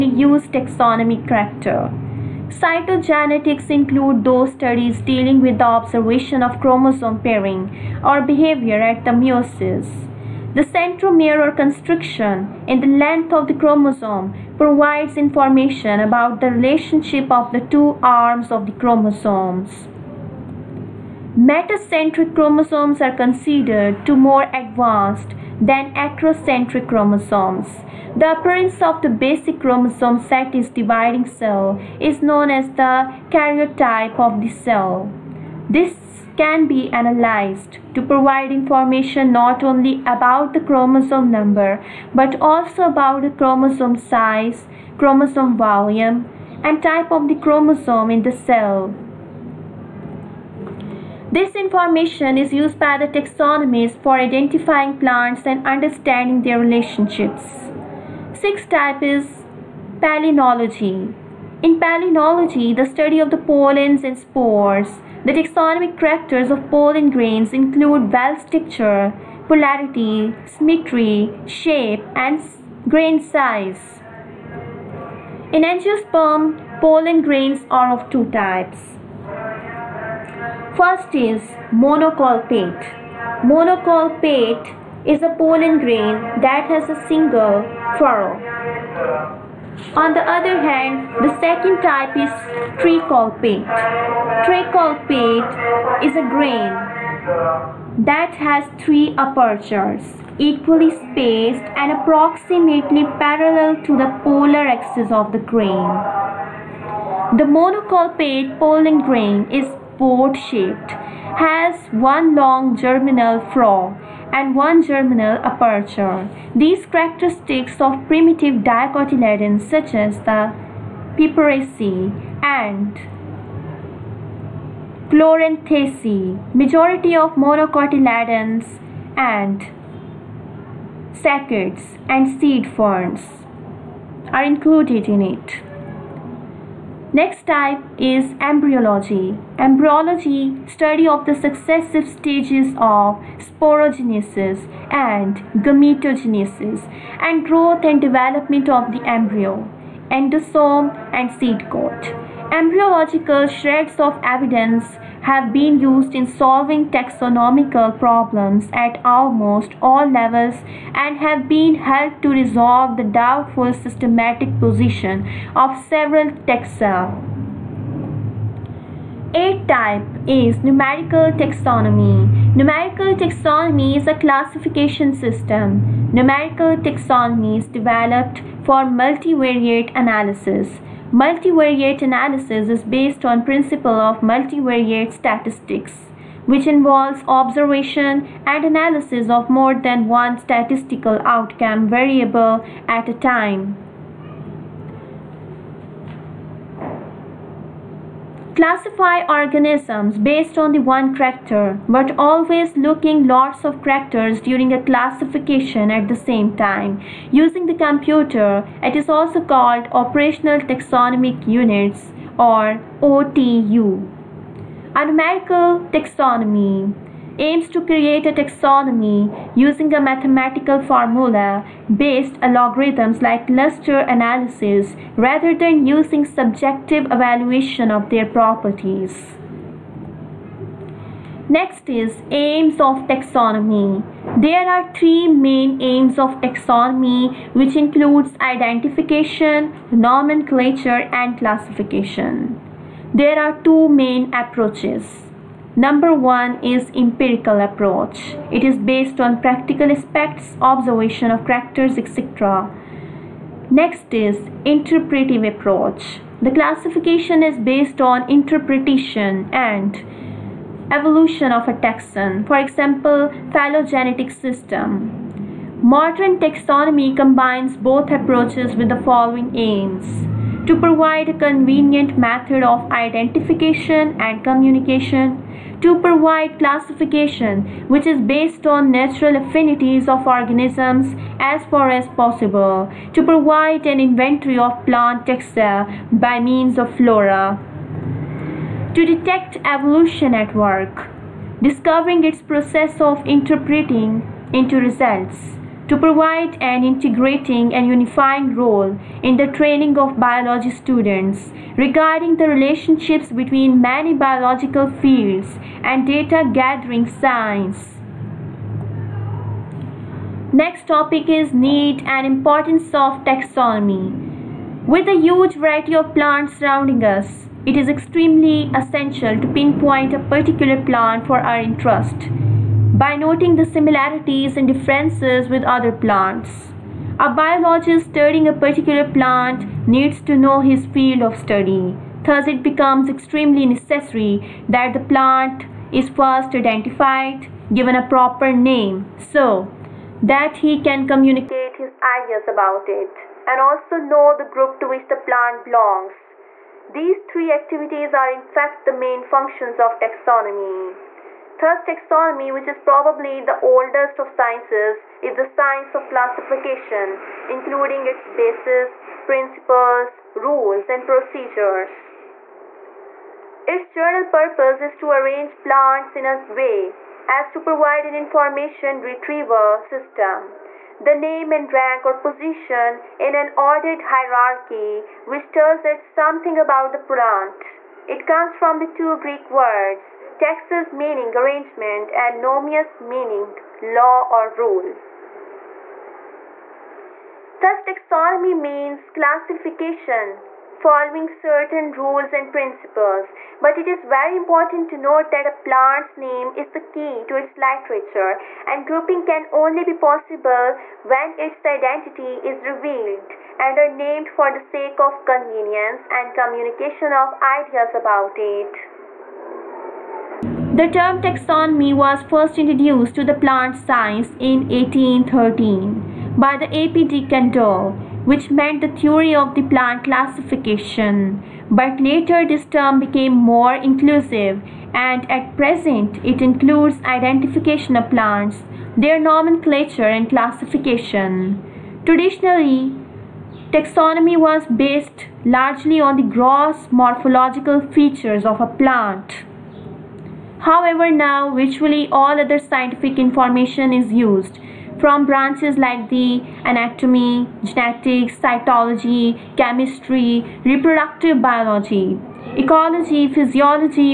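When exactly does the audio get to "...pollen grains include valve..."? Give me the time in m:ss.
1:06.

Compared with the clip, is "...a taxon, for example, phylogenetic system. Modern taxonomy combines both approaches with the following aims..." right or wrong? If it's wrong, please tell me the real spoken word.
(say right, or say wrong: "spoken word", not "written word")
right.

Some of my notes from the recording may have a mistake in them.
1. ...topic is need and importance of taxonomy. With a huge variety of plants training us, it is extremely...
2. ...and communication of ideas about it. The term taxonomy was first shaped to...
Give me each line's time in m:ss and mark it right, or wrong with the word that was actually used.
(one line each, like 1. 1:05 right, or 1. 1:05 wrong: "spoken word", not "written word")
1. 5:10 wrong: "surrounding", not "training"
2. 6:46 wrong: "introduced", not "shaped".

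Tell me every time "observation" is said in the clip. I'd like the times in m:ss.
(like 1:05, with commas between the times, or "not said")
0:05, 3:07, 4:10.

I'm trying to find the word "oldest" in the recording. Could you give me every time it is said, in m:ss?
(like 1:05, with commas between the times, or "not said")
5:53.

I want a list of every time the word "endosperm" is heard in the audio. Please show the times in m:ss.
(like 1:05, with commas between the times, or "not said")
2:30.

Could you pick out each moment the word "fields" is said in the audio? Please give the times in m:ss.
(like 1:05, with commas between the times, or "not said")
5:05, 5:30.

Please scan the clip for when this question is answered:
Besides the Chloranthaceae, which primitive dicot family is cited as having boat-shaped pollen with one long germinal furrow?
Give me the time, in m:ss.
2:01.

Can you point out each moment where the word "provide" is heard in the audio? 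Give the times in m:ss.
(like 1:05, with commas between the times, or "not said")
0:14, 0:38, 4:30, 4:36, 4:43, 4:55, 6:07.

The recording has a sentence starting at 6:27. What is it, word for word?
Thus, taxonomy means classification, following certain rules and principles.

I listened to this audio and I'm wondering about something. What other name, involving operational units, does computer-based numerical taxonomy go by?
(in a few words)
Operational Taxonomic Units.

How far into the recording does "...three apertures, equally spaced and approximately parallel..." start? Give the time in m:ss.
1:38.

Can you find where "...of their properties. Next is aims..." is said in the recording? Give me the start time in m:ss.
3:47.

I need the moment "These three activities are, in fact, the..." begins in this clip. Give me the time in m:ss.
5:46.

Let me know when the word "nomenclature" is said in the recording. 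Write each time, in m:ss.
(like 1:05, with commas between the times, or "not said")
3:59, 7:09.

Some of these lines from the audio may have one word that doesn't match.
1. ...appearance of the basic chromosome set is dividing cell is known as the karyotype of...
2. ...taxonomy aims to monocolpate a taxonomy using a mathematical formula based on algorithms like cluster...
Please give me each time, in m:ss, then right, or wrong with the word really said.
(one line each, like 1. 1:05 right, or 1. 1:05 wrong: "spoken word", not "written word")
1. 0:28 right
2. 3:35 wrong: "create", not "monocolpate".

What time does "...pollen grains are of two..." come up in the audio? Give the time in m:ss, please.
1:16.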